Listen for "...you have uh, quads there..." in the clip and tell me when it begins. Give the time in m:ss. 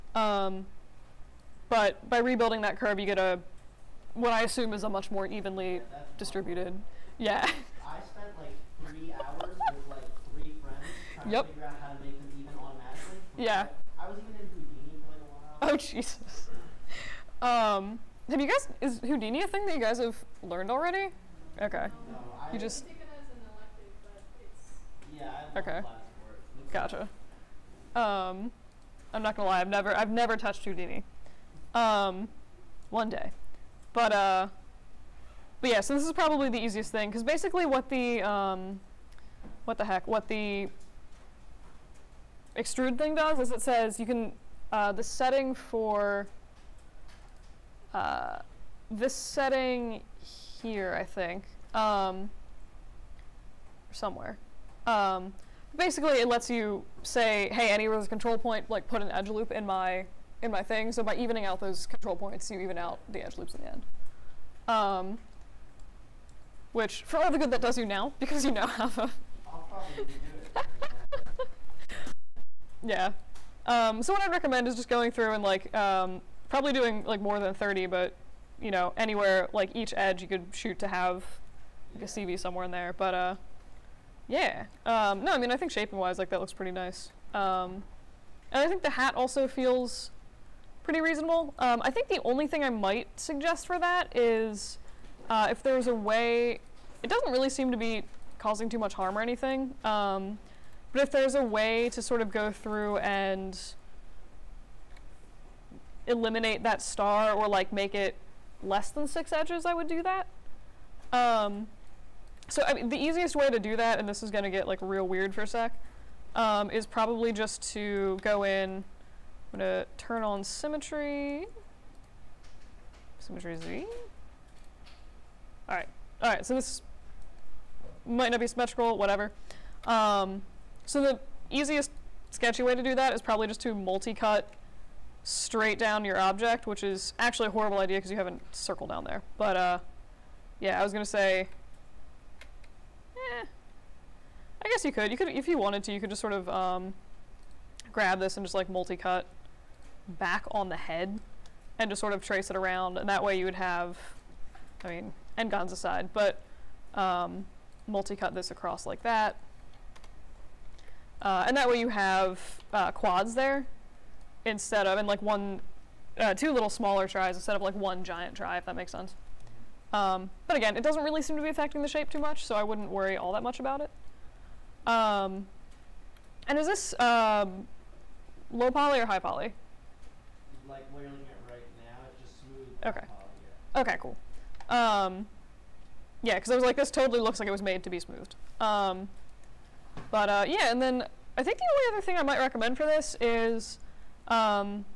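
2:41.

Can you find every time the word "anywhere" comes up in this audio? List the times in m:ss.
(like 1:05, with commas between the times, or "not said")
0:57, 1:18.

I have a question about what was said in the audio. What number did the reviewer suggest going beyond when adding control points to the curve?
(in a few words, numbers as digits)
30.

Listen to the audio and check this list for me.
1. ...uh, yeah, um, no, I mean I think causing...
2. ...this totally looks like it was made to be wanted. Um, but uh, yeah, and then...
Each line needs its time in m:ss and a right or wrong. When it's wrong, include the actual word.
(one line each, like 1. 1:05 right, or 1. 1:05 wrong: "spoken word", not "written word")
1. 1:23 wrong: "shaping", not "causing"
2. 3:06 wrong: "smoothed", not "wanted".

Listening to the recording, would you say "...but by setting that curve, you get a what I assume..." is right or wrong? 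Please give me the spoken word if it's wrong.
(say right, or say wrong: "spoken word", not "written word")
wrong: "rebuilding", not "setting".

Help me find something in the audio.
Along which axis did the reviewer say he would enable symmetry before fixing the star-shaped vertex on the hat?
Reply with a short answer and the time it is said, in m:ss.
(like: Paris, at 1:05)
Z, at 2:03.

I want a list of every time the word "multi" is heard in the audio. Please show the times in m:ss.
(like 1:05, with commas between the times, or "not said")
2:13, 2:28, 2:37.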